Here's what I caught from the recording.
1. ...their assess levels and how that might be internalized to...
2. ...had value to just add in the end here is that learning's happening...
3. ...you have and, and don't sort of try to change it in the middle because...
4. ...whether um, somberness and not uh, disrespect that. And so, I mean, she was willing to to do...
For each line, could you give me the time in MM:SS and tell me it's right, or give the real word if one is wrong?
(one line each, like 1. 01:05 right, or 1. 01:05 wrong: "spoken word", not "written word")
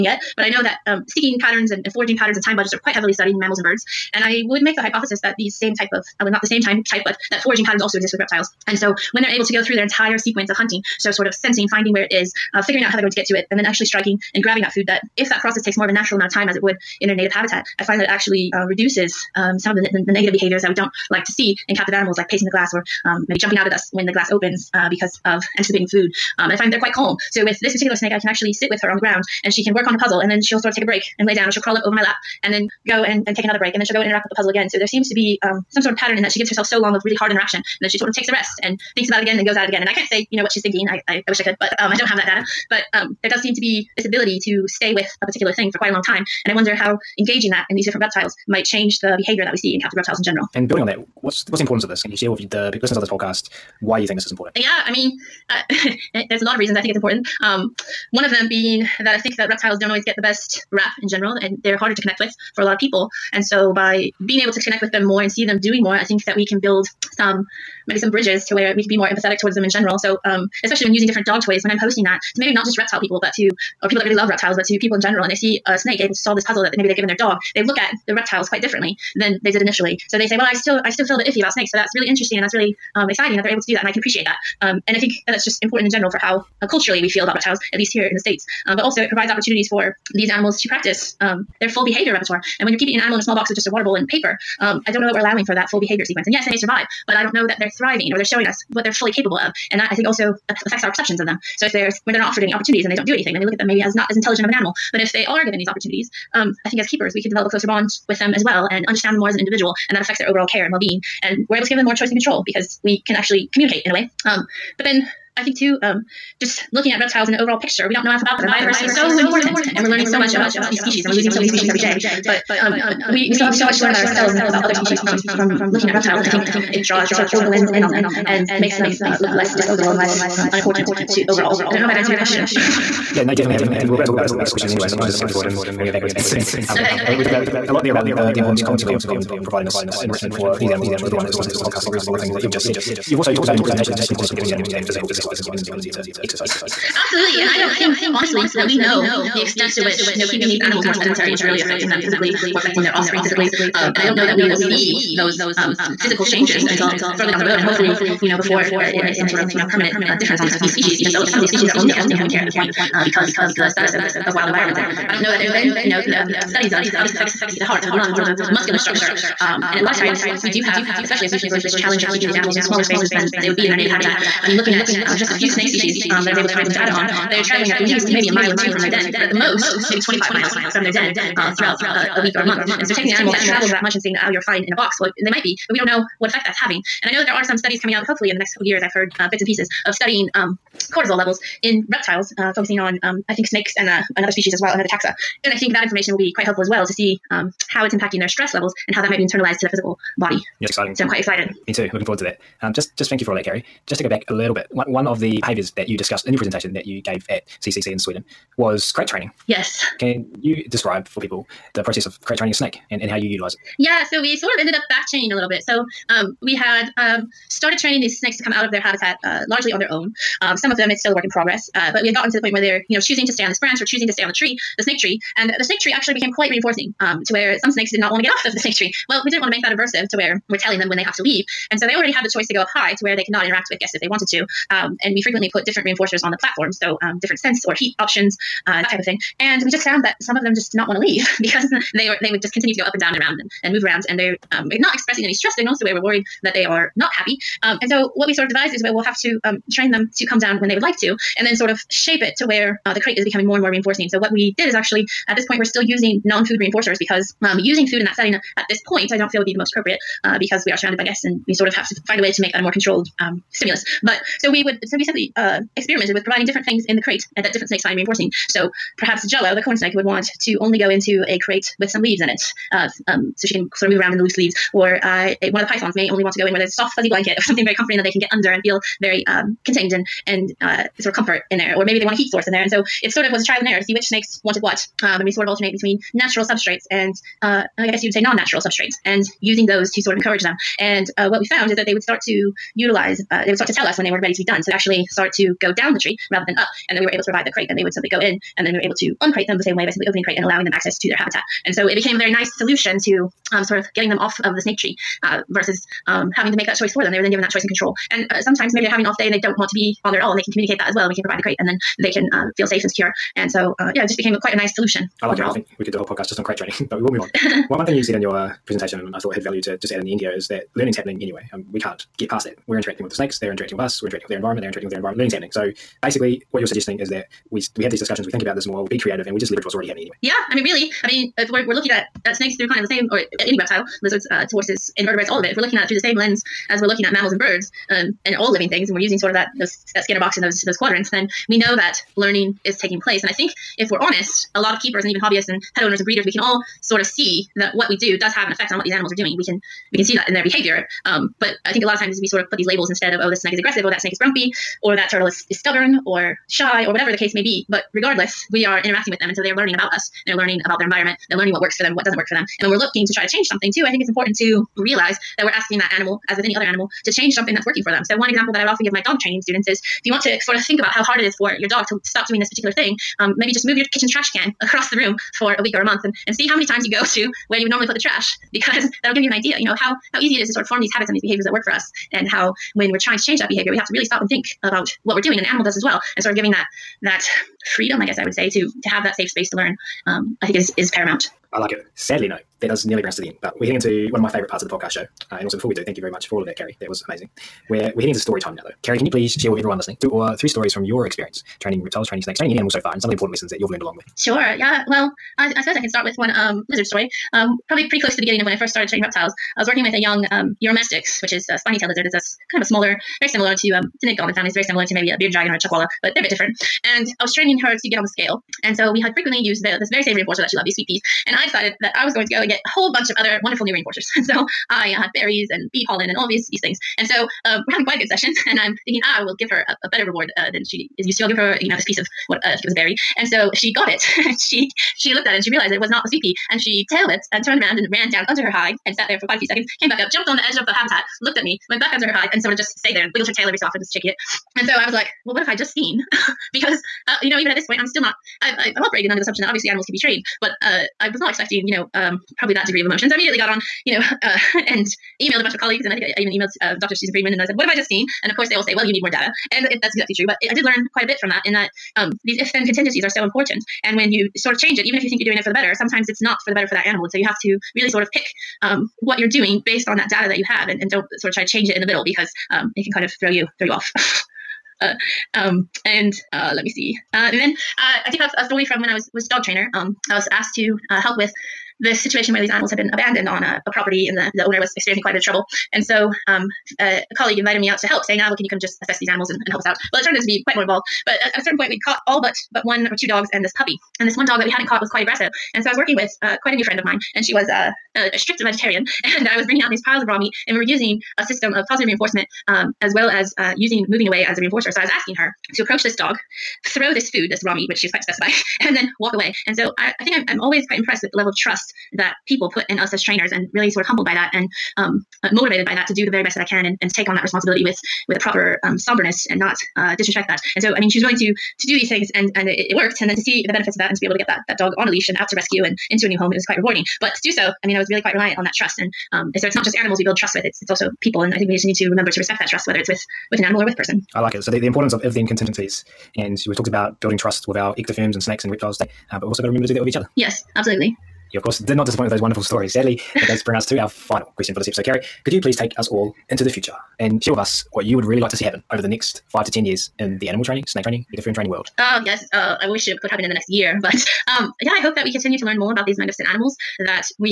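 1. 03:18 wrong: "stress", not "assess"
2. 05:19 right
3. 07:50 right
4. 08:38 wrong: "proper", not "whether".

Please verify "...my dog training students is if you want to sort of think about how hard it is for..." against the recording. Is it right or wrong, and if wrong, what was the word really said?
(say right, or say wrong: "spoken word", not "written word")
right.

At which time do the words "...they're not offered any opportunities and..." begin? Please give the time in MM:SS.
01:42.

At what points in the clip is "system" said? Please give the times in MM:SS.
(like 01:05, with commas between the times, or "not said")
08:21.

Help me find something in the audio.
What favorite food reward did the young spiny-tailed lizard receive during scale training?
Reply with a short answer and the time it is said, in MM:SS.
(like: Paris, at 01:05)
Sweet peas, at 07:00.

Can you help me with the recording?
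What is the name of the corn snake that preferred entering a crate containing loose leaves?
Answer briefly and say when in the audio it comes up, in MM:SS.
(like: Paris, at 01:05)
Jello, at 04:29.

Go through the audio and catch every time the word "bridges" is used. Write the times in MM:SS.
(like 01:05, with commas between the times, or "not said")
01:08.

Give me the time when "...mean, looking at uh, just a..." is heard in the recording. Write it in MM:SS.
02:54.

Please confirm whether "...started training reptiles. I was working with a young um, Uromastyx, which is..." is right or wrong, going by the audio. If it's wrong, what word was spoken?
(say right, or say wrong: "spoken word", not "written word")
right.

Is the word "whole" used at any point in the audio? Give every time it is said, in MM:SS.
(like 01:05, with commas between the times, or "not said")
05:15, 07:02.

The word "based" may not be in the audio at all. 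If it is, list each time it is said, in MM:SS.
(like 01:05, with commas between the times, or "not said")
07:49.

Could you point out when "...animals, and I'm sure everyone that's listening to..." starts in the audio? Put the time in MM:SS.
02:20.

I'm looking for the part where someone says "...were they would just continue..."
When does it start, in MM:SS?
04:02.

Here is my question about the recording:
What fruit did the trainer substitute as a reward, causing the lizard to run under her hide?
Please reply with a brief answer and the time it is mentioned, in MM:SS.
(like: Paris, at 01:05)
A berry, at 07:12.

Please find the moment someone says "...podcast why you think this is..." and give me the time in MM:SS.
00:53.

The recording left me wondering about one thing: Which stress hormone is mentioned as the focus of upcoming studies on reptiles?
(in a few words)
Cortisol.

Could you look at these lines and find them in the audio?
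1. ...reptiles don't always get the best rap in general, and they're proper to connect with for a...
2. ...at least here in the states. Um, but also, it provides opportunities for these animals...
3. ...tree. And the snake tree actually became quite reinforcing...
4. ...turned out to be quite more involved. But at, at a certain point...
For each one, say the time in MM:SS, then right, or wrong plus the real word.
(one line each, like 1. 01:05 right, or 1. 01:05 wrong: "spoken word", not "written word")
1. 00:59 wrong: "harder", not "proper"
2. 01:27 right
3. 03:44 right
4. 08:10 right.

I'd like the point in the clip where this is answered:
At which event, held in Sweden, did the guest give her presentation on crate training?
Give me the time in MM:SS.
03:27.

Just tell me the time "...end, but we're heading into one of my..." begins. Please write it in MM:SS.
06:33.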